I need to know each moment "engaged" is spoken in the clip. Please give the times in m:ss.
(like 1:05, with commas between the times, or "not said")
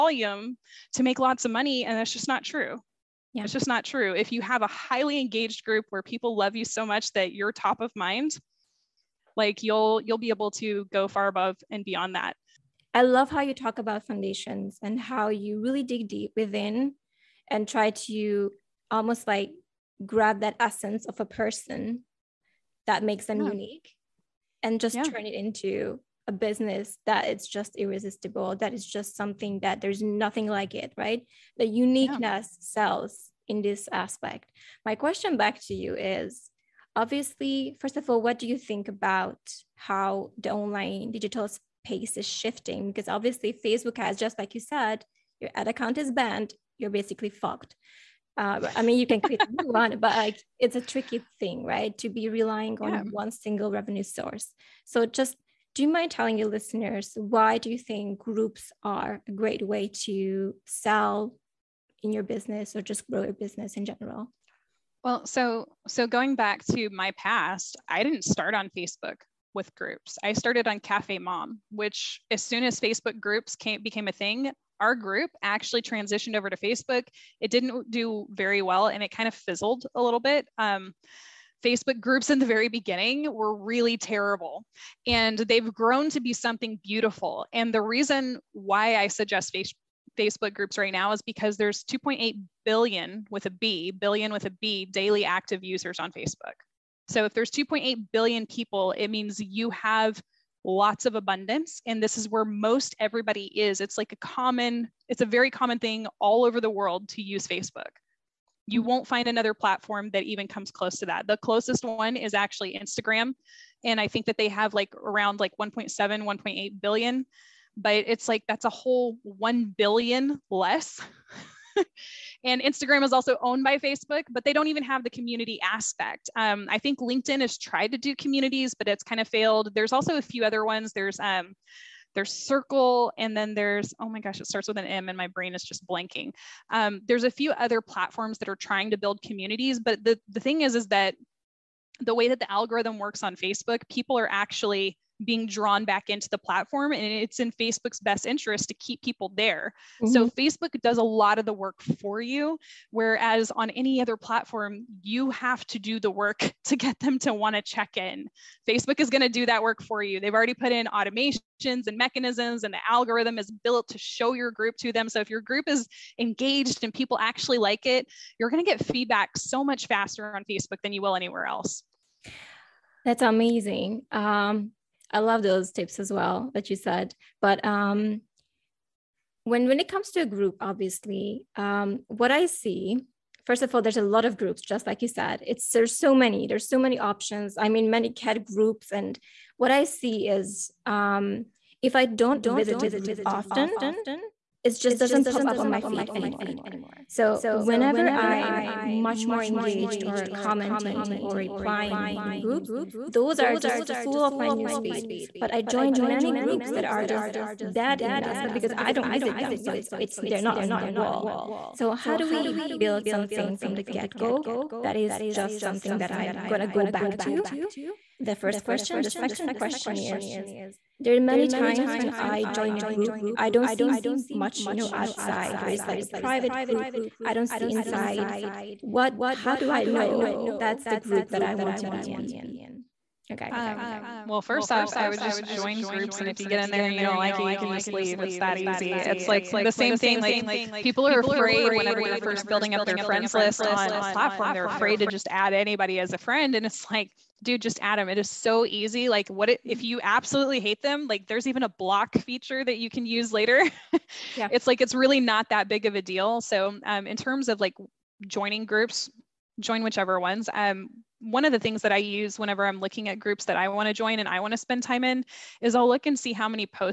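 0:05, 2:46, 3:19.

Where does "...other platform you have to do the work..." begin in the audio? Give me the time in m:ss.
2:34.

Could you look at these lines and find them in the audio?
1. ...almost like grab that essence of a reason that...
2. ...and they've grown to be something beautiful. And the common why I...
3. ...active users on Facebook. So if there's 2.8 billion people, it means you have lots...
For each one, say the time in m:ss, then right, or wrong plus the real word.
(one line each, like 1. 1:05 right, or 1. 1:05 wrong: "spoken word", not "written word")
1. 0:18 wrong: "person", not "reason"
2. 1:25 wrong: "reason", not "common"
3. 1:35 right.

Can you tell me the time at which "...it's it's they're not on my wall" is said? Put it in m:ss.
3:29.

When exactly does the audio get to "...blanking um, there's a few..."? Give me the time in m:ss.
2:15.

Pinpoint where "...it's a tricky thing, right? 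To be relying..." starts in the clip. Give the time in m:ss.
0:50.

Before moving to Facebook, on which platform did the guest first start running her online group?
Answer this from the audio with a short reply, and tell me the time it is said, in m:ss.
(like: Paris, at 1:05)
Cafe Mom, at 1:10.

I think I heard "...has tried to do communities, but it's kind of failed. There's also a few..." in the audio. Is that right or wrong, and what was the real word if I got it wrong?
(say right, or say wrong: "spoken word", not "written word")
right.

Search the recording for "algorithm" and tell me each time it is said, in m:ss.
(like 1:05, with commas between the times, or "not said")
2:22, 2:42.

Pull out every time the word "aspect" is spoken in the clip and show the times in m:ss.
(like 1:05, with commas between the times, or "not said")
0:33, 2:05, 3:28.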